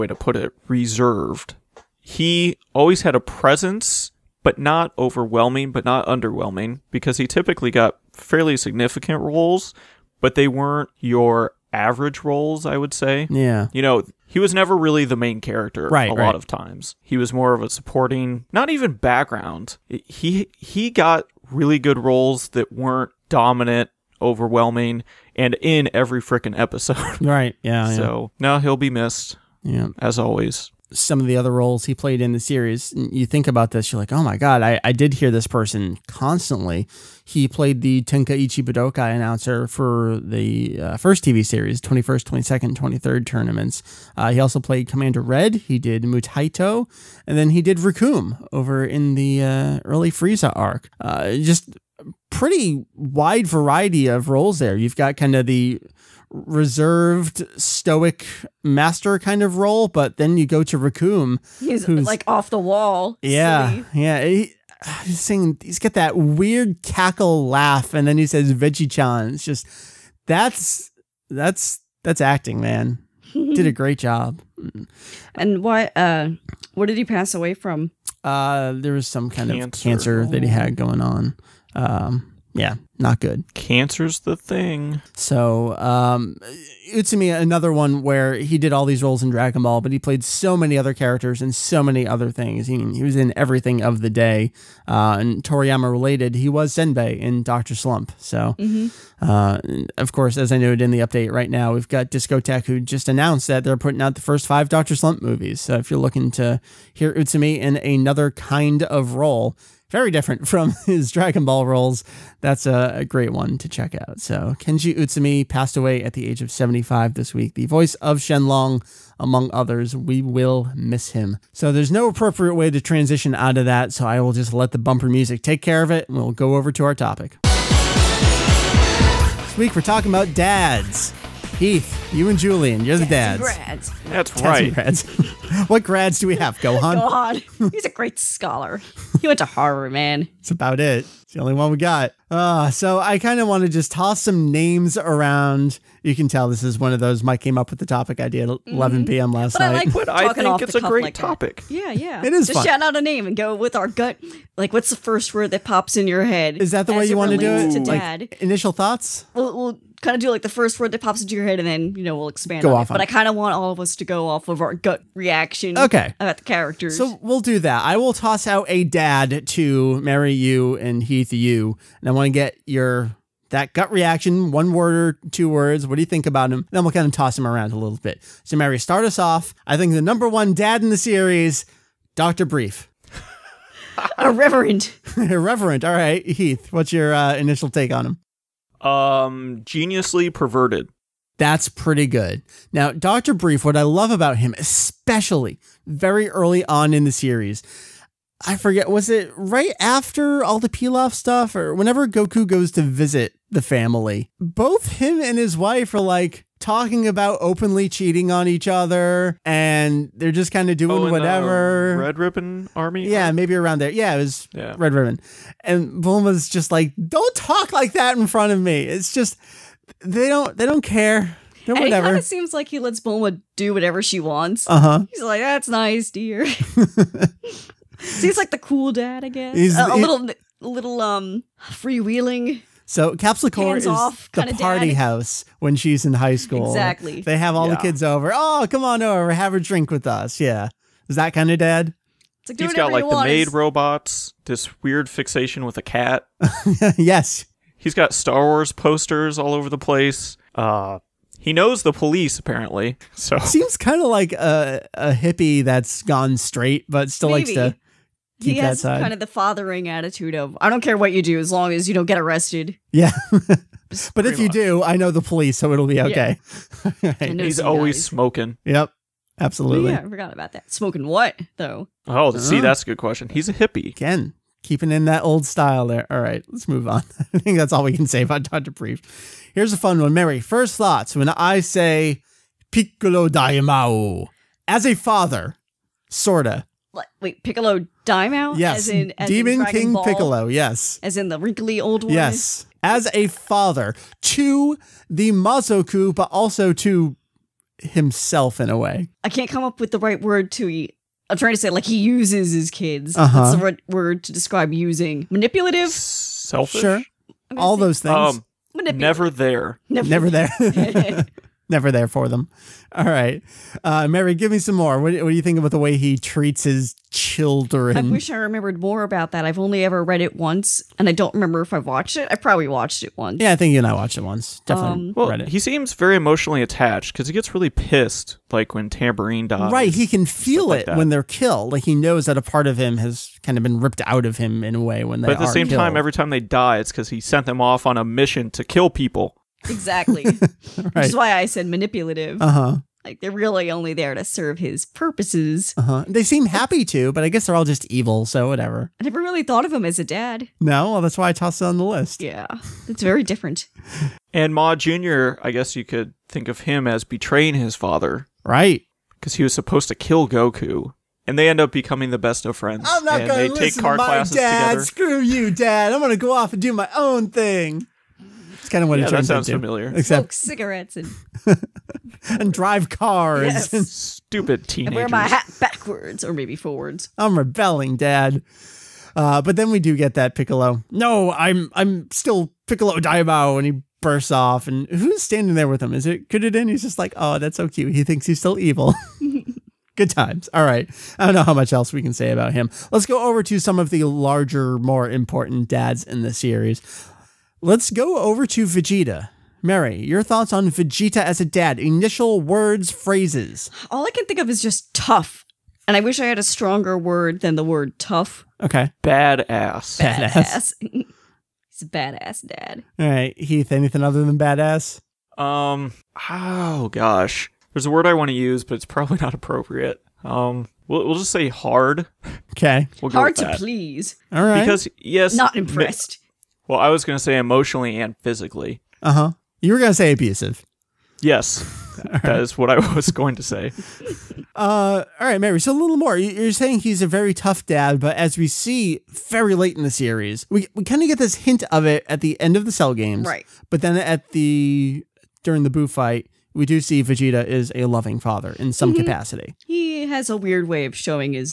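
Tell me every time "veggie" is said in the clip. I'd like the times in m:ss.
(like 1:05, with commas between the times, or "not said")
1:08.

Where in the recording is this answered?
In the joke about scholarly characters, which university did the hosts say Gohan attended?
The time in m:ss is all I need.
2:19.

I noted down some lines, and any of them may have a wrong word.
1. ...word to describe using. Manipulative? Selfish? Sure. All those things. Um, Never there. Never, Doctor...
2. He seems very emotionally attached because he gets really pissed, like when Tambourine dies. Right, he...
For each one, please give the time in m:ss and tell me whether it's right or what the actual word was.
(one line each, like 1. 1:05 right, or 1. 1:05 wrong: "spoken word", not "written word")
1. 5:03 wrong: "Never", not "Doctor"
2. 5:25 right.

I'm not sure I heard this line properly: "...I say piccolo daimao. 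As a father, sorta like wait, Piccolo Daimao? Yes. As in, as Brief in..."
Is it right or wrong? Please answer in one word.
wrong.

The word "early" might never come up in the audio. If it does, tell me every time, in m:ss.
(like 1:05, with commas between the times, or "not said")
0:49, 3:16.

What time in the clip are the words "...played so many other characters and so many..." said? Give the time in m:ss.
1:29.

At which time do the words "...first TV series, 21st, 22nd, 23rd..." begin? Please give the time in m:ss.
0:40.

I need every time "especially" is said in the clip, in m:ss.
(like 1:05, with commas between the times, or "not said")
3:14.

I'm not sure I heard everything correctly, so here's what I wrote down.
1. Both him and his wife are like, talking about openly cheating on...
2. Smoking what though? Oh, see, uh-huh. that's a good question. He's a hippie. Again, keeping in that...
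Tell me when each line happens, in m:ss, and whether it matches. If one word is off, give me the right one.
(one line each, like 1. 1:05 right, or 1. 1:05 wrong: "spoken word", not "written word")
1. 3:24 right
2. 4:30 right.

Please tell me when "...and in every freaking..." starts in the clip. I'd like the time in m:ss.
0:25.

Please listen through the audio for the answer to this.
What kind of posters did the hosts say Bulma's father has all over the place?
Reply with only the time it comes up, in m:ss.
4:08.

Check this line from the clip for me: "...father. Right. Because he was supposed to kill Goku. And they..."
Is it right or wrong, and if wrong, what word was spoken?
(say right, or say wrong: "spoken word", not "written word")
right.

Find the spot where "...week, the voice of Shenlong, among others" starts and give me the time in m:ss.
1:57.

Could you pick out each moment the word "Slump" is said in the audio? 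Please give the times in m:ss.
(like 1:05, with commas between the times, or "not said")
1:37, 1:44.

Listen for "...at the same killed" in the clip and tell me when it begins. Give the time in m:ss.
5:35.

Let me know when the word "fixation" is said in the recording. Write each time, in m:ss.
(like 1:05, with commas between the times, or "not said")
4:05.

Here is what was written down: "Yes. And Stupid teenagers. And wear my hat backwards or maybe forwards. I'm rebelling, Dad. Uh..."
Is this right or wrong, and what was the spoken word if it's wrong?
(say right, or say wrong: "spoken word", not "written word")
right.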